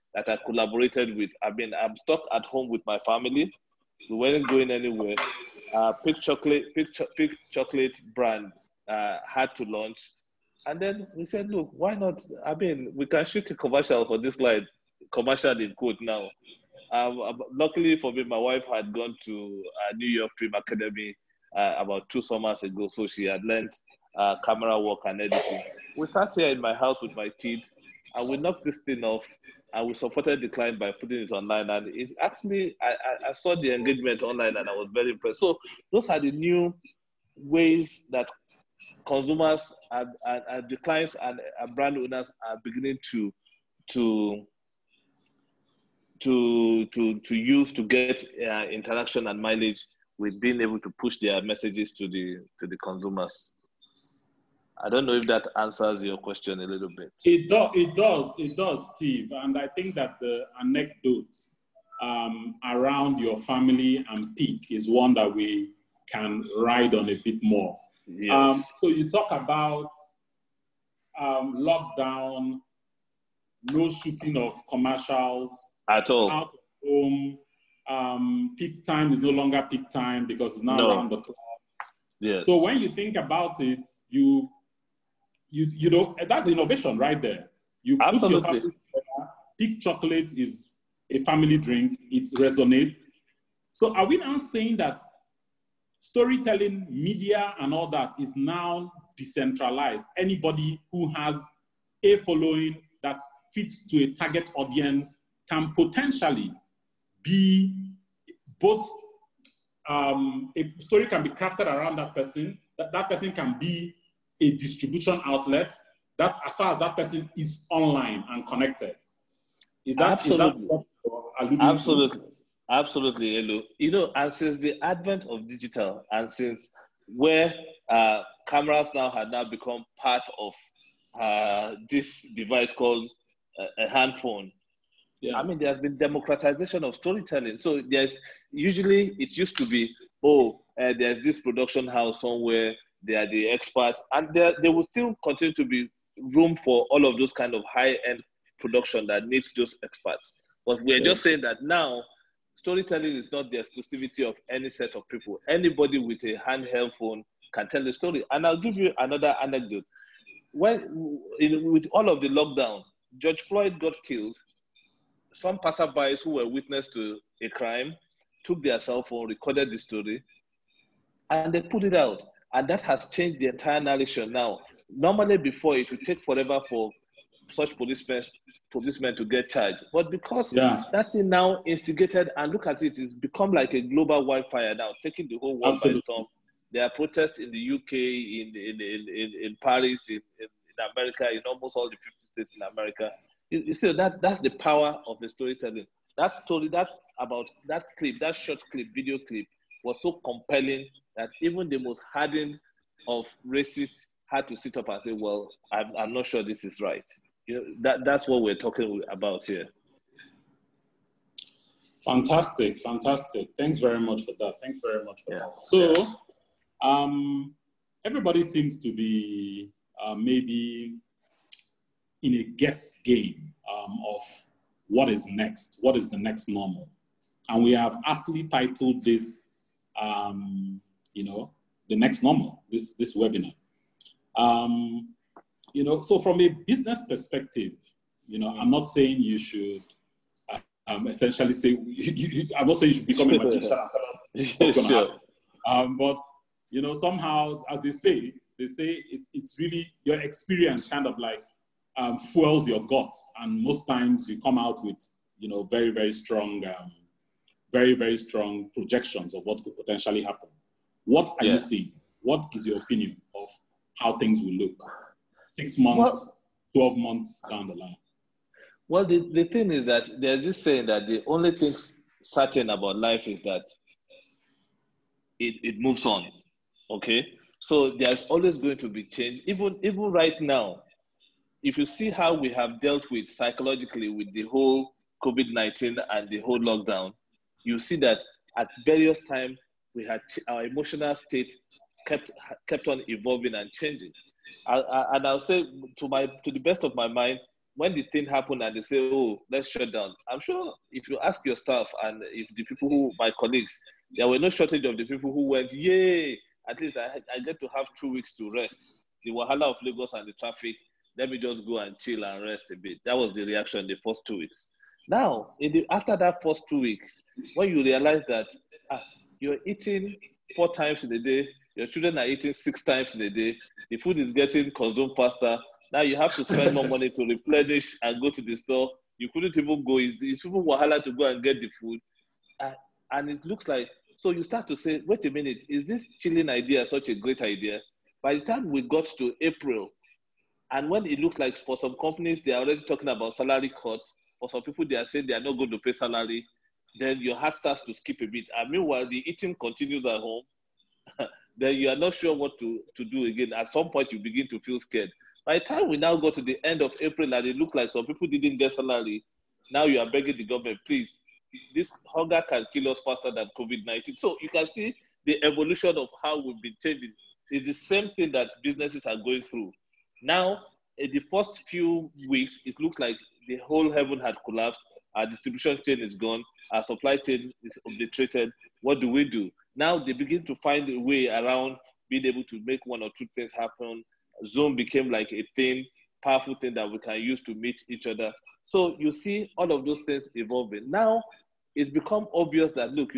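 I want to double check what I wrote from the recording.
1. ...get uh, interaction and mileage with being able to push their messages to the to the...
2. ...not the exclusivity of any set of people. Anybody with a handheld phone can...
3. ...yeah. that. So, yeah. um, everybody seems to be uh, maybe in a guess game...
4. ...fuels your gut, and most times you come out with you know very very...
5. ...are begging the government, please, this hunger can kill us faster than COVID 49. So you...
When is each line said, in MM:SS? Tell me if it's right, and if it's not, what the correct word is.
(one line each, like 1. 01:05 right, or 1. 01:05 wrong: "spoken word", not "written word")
1. 00:47 right
2. 02:33 right
3. 03:35 right
4. 04:12 right
5. 05:59 wrong: "19", not "49".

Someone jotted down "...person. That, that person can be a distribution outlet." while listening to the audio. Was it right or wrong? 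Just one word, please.
right.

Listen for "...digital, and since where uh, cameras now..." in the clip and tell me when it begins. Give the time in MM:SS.
02:05.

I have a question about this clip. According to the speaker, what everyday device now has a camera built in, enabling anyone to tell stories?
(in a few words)
handphone.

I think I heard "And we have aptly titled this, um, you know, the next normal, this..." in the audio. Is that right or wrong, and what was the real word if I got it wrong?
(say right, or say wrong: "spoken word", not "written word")
right.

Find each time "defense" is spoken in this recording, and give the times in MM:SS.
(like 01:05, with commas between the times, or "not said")
not said.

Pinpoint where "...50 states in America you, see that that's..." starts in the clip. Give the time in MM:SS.
03:11.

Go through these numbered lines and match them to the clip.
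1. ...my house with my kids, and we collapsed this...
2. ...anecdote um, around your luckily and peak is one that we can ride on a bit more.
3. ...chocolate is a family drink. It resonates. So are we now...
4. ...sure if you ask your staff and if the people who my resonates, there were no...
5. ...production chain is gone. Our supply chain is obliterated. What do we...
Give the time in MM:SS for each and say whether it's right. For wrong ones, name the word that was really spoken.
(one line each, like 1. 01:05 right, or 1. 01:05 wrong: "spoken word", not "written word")
1. 00:26 wrong: "knocked", not "collapsed"
2. 01:00 wrong: "family", not "luckily"
3. 01:29 right
4. 05:00 wrong: "colleagues", not "resonates"
5. 06:15 wrong: "distribution", not "production".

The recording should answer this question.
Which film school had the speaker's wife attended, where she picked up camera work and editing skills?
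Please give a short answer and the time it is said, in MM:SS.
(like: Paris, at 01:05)
New York Film Academy, at 00:19.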